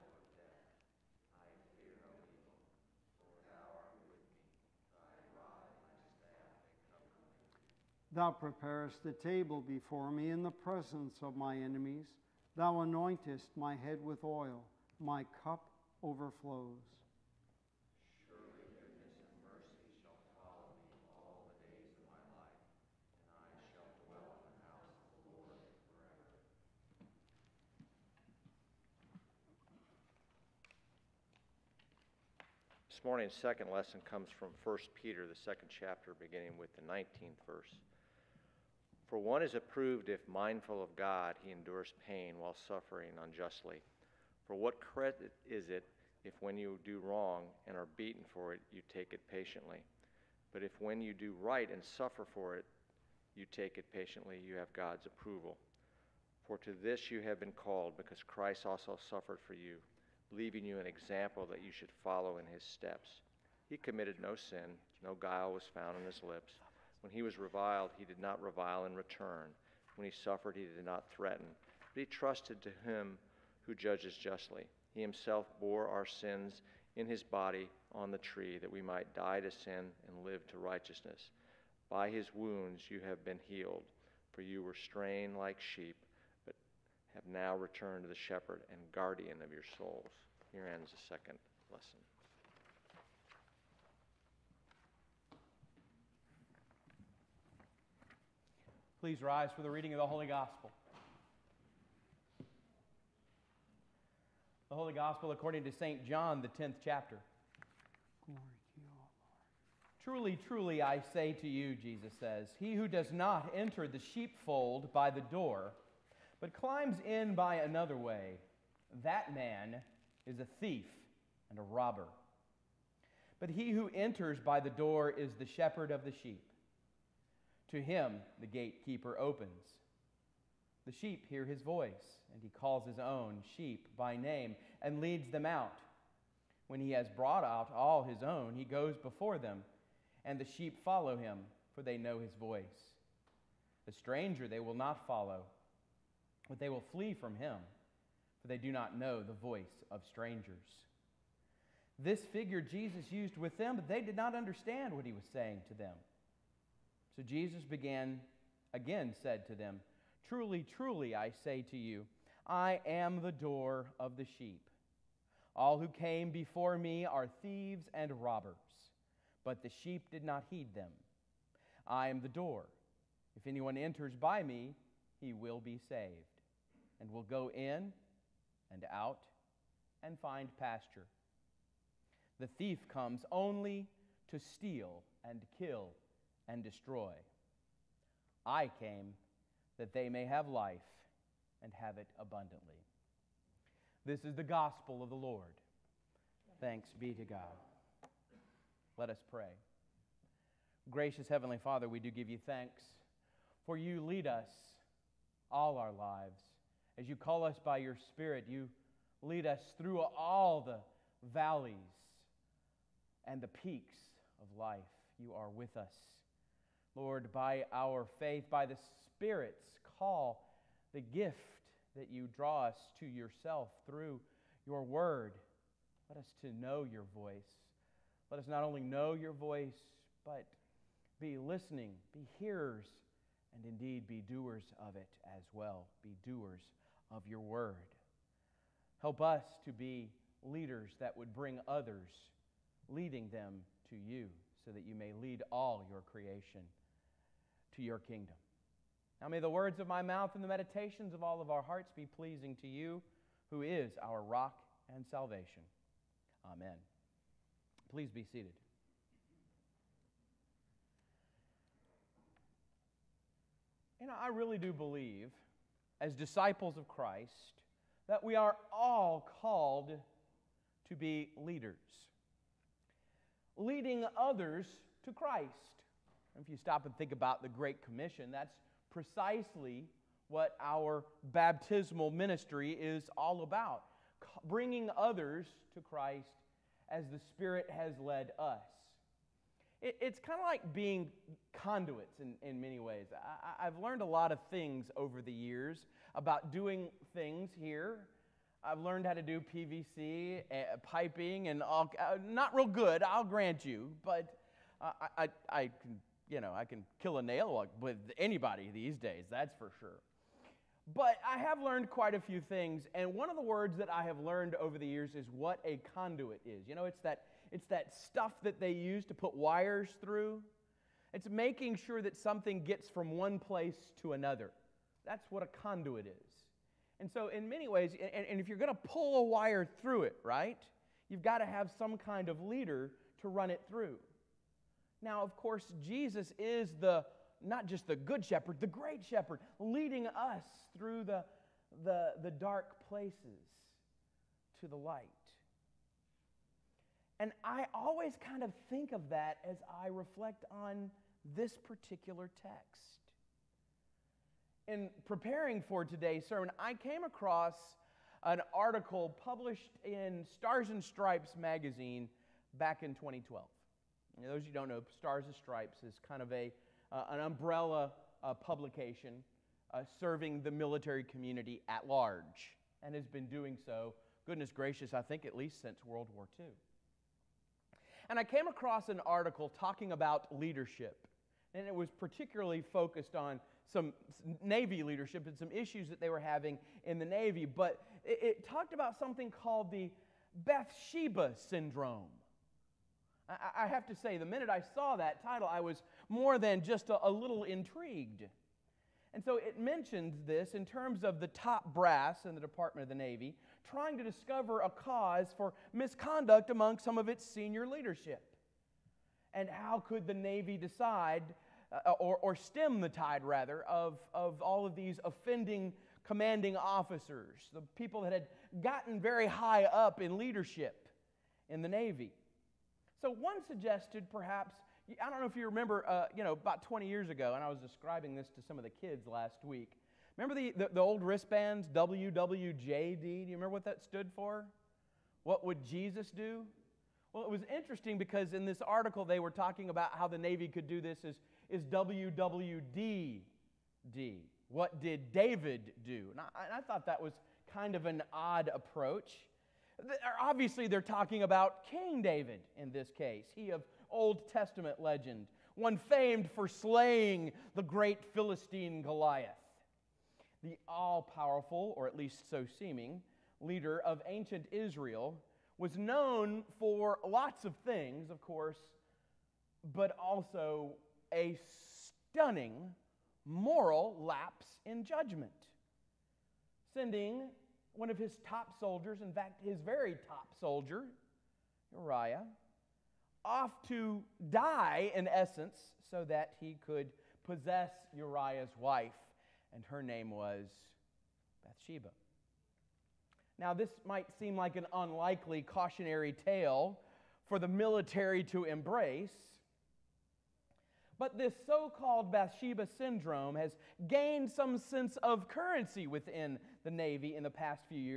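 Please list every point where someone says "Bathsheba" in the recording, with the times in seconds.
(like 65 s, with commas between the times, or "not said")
390 s, 491 s, 502 s.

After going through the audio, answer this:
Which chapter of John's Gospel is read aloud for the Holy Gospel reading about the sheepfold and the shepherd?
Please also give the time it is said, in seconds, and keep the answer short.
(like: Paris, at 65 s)
10th, at 106 s.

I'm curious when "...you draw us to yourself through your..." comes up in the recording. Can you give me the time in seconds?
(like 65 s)
222 s.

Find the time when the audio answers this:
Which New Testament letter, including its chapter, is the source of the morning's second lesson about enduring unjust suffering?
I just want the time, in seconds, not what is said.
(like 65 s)
34 s.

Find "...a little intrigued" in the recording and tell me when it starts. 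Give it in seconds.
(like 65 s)
397 s.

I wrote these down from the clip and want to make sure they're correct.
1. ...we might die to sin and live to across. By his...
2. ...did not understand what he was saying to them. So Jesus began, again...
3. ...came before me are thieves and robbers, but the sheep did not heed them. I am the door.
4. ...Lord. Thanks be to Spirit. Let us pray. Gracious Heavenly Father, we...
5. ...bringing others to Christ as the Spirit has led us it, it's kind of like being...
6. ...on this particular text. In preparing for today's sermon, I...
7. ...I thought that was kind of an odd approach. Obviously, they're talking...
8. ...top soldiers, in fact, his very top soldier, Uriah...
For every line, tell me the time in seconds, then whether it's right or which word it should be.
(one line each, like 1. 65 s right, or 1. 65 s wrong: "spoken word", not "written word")
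1. 78 s wrong: "righteousness", not "across"
2. 154 s right
3. 165 s right
4. 195 s wrong: "God", not "Spirit"
5. 284 s right
6. 350 s right
7. 446 s right
8. 478 s right.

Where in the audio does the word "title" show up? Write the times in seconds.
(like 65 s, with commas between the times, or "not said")
395 s.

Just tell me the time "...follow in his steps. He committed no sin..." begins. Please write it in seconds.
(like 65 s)
62 s.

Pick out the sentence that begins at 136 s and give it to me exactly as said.
When he has brought out all his own, he goes before them, and the sheep follow him, for they know his voice.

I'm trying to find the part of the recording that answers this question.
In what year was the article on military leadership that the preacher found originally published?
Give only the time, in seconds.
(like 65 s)
362 s.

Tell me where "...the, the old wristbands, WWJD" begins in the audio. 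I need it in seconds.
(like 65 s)
430 s.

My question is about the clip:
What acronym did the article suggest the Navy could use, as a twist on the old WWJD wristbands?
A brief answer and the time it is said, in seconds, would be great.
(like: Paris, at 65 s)
WWDD, at 441 s.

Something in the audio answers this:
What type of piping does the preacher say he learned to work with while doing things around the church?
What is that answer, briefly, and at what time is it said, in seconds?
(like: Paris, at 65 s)
PVC, at 299 s.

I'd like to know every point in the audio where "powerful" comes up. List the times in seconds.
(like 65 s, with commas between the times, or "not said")
461 s.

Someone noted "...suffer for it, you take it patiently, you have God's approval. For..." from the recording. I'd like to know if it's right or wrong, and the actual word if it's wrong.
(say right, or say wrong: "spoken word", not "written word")
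right.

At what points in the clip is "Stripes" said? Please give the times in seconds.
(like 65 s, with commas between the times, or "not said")
360 s, 365 s.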